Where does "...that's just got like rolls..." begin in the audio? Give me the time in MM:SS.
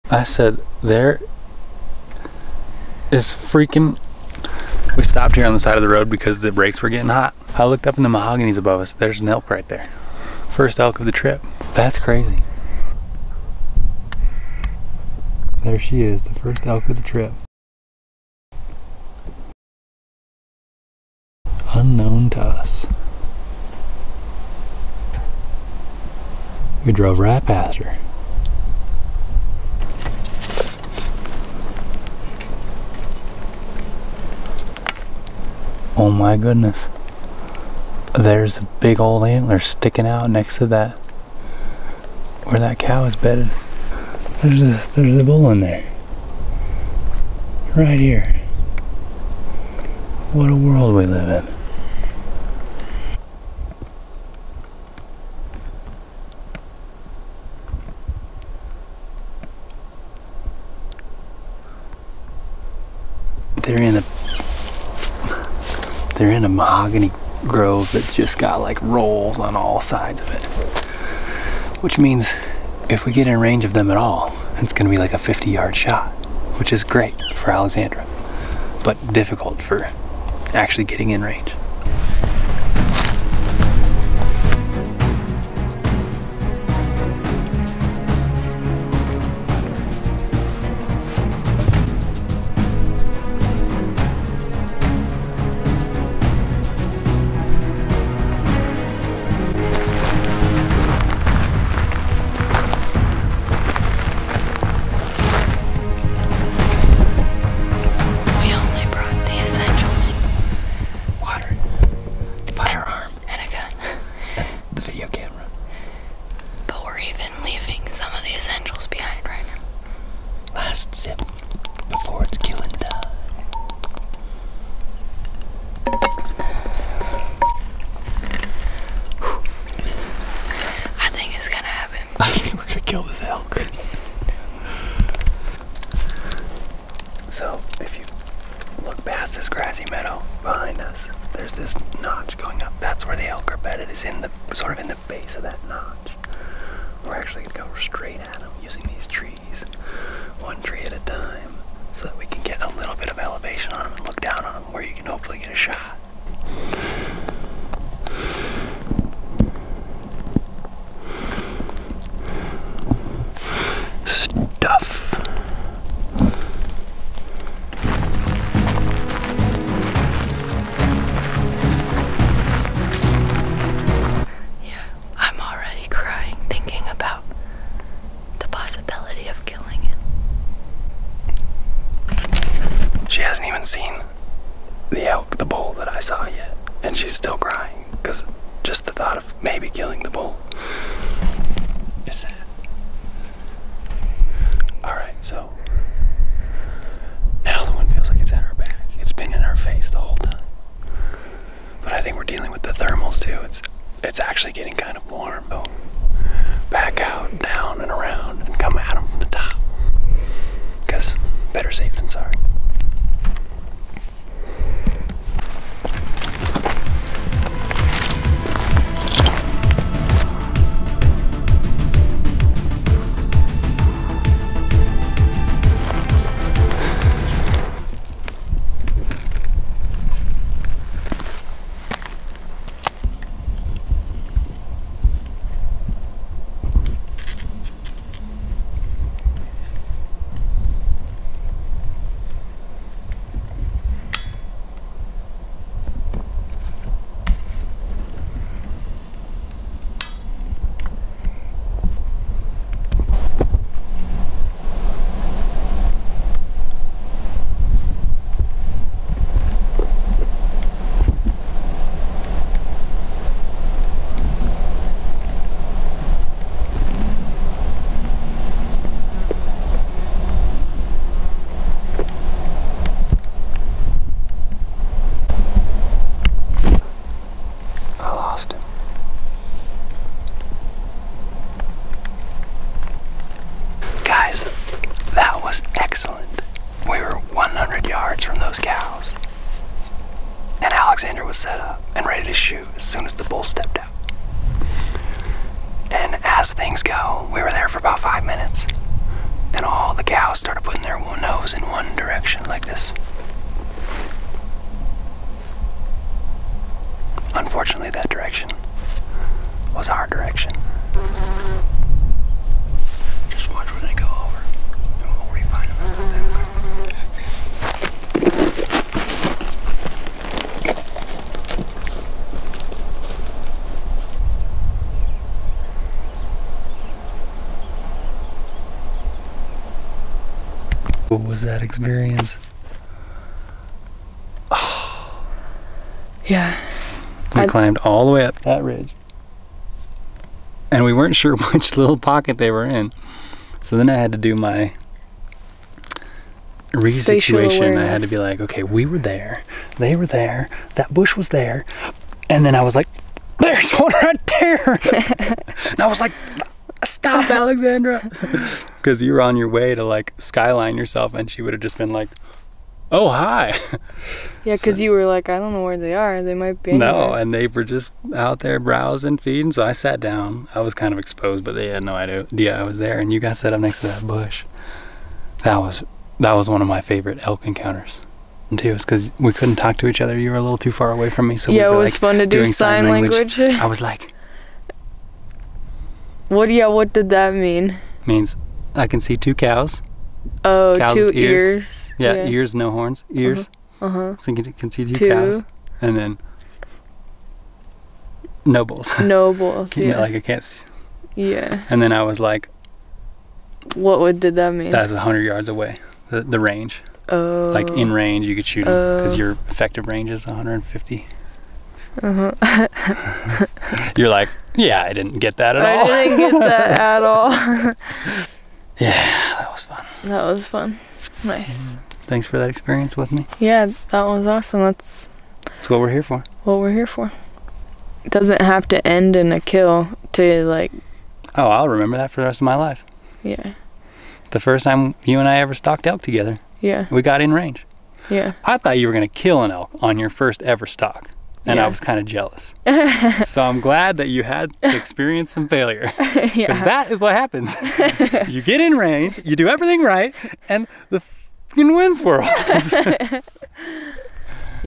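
01:07.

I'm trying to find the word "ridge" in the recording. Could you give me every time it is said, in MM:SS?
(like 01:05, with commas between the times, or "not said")
05:38.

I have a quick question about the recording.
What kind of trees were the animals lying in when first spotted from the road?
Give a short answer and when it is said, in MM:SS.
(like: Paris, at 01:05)
mahoganies, at 00:08.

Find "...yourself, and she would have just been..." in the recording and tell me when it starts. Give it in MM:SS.
06:00.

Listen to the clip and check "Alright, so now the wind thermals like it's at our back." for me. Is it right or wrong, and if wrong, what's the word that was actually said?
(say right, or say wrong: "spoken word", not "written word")
wrong: "feels", not "thermals".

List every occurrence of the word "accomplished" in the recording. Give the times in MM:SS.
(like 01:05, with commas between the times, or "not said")
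not said.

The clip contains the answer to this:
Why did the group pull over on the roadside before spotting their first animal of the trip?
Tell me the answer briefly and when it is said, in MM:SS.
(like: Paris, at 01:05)
brakes were getting hot, at 00:06.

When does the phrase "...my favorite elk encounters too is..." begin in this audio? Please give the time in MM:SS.
06:16.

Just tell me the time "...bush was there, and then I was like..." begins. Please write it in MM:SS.
05:50.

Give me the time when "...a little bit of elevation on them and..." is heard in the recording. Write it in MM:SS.
02:32.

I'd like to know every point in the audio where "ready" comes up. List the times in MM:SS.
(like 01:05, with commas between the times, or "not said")
04:52.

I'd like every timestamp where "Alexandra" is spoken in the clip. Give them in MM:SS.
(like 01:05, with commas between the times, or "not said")
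01:17, 04:51, 05:57.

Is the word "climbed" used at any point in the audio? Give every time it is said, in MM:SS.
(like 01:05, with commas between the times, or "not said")
05:37.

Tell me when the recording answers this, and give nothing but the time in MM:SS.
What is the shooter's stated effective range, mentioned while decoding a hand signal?
06:50.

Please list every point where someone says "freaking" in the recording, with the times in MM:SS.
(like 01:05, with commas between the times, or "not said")
00:03, 07:30.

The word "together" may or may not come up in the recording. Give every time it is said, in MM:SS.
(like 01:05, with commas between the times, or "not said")
07:16.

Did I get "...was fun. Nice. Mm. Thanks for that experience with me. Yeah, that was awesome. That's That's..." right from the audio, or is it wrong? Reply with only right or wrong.
right.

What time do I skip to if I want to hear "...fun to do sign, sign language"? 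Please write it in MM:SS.
06:21.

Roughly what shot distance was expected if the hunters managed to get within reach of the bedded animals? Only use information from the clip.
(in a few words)
50 yards.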